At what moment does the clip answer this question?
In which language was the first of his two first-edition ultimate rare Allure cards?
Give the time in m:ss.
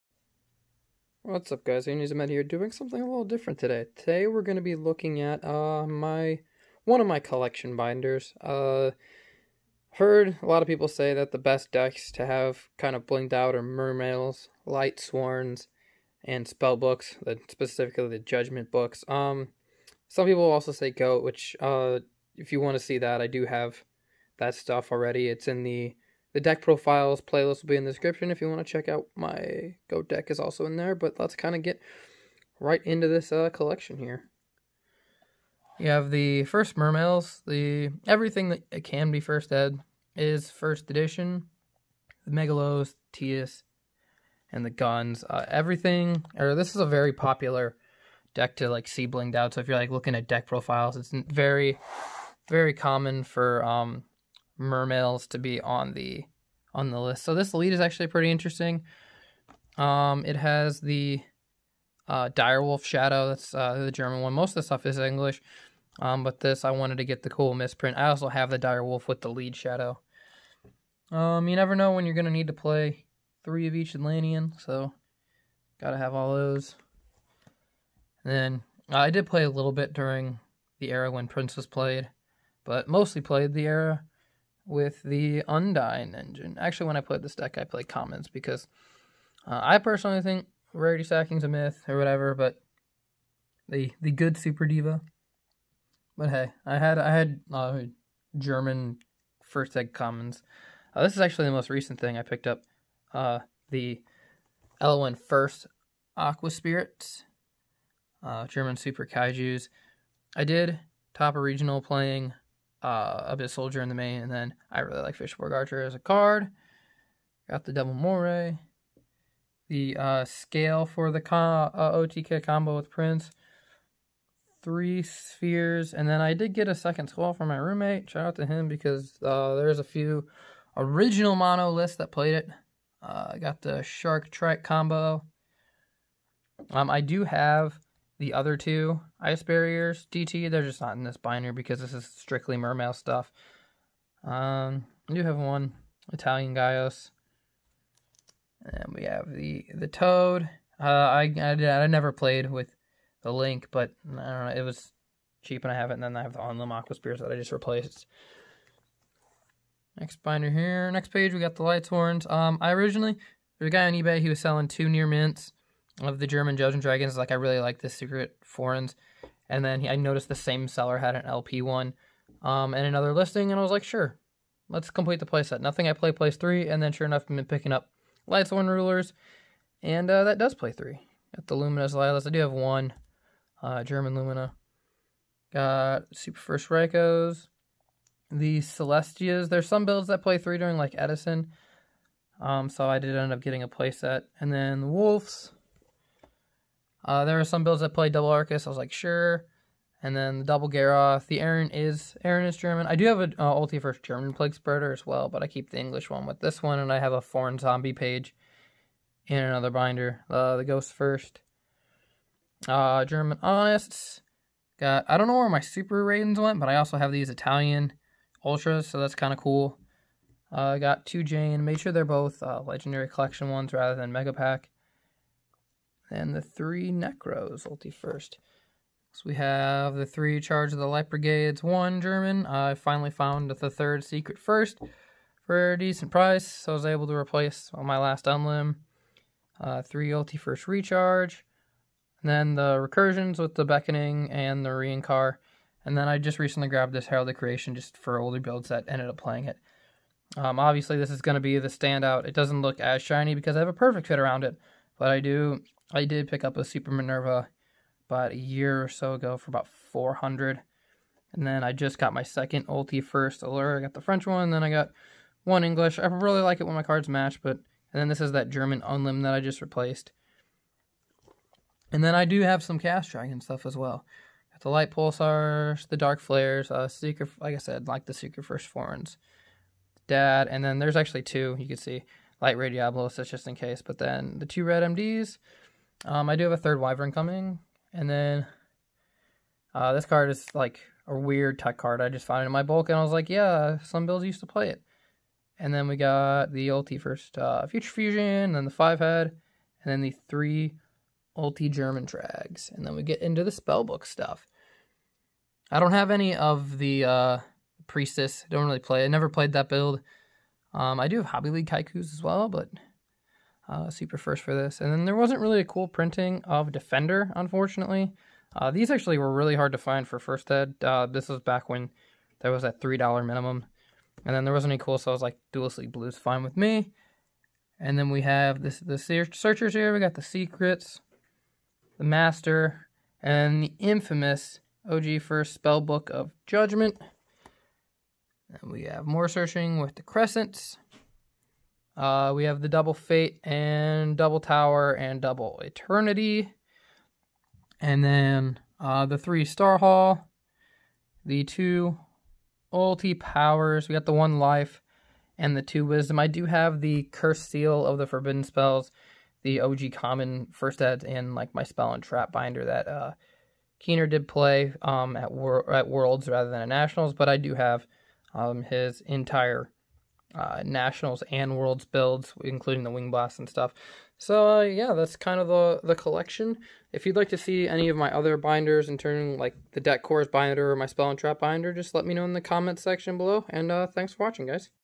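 4:24.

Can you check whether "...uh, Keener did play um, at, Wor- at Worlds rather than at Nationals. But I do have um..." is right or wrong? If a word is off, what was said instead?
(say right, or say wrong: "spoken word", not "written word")
right.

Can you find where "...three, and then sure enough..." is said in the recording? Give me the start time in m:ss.
2:56.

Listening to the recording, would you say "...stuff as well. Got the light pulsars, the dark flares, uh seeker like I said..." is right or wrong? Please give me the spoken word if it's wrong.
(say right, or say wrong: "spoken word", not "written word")
right.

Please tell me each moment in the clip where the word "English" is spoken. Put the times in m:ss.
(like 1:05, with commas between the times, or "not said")
1:04, 3:25, 4:25.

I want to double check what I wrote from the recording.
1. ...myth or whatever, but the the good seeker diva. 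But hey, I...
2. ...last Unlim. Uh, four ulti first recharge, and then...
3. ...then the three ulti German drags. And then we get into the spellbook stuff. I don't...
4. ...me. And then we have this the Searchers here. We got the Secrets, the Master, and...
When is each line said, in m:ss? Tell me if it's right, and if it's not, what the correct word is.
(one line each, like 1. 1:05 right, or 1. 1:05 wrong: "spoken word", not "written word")
1. 1:31 wrong: "super", not "seeker"
2. 3:57 wrong: "three", not "four"
3. 4:59 right
4. 5:26 right.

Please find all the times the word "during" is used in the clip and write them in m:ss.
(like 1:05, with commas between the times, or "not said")
1:19, 3:10.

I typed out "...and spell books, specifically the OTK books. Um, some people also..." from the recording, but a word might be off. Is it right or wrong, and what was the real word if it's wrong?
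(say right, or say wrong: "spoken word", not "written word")
wrong: "Judgment", not "OTK".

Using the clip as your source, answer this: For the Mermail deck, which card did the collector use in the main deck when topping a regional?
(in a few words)
Abyss Soldier.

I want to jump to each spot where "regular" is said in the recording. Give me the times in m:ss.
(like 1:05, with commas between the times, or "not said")
not said.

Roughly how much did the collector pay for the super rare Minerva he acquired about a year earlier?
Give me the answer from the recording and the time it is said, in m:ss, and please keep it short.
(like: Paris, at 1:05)
400, at 4:19.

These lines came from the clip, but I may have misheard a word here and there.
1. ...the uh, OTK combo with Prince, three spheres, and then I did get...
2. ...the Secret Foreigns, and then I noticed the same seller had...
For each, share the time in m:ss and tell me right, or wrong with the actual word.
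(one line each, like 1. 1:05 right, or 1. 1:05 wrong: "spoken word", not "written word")
1. 2:01 right
2. 2:47 right.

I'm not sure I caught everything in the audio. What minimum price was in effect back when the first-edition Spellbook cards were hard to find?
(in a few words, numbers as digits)
$3.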